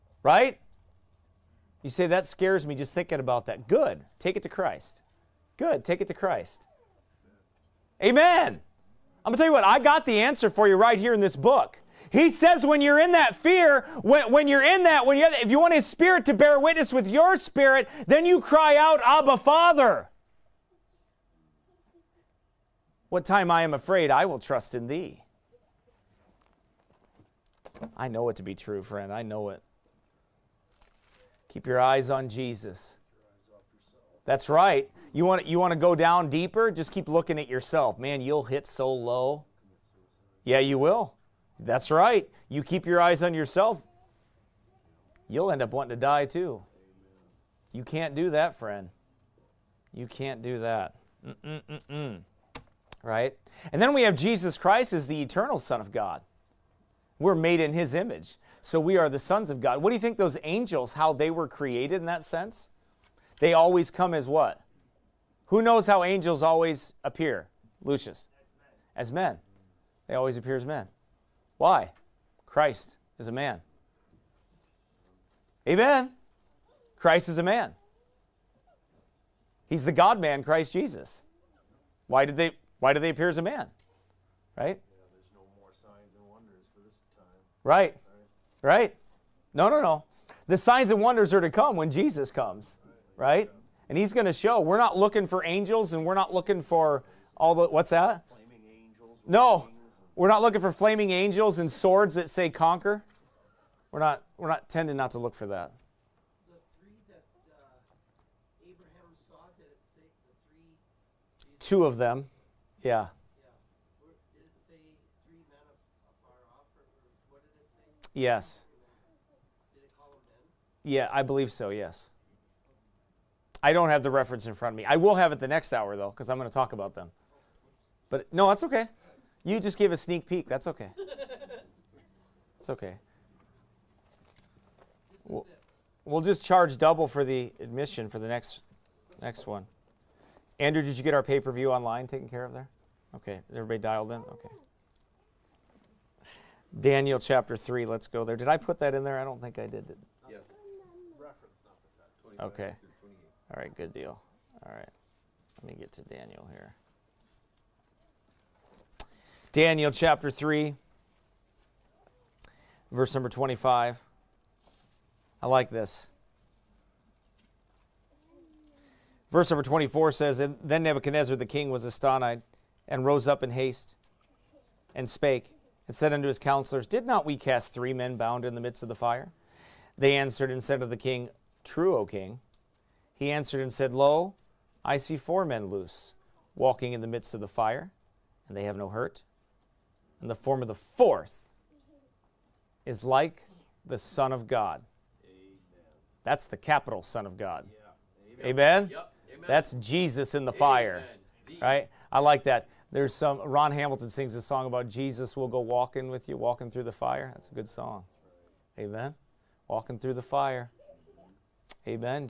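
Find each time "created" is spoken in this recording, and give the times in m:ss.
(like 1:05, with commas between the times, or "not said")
1:01.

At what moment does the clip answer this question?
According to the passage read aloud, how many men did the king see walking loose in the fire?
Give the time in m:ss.
3:05.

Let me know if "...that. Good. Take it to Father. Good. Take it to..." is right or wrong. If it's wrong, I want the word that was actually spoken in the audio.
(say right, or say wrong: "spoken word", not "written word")
wrong: "Christ", not "Father".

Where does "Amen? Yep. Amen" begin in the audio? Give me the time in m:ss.
3:18.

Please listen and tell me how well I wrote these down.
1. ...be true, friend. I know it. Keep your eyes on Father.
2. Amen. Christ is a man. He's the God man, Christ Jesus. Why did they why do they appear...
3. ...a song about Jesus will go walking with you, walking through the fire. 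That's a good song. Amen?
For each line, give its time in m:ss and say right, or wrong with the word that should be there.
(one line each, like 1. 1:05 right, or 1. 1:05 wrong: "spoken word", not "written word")
1. 0:28 wrong: "Jesus", not "Father"
2. 1:15 right
3. 3:24 right.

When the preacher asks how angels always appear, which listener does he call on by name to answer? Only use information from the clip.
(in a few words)
Lucius.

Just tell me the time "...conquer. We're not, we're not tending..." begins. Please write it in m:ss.
1:42.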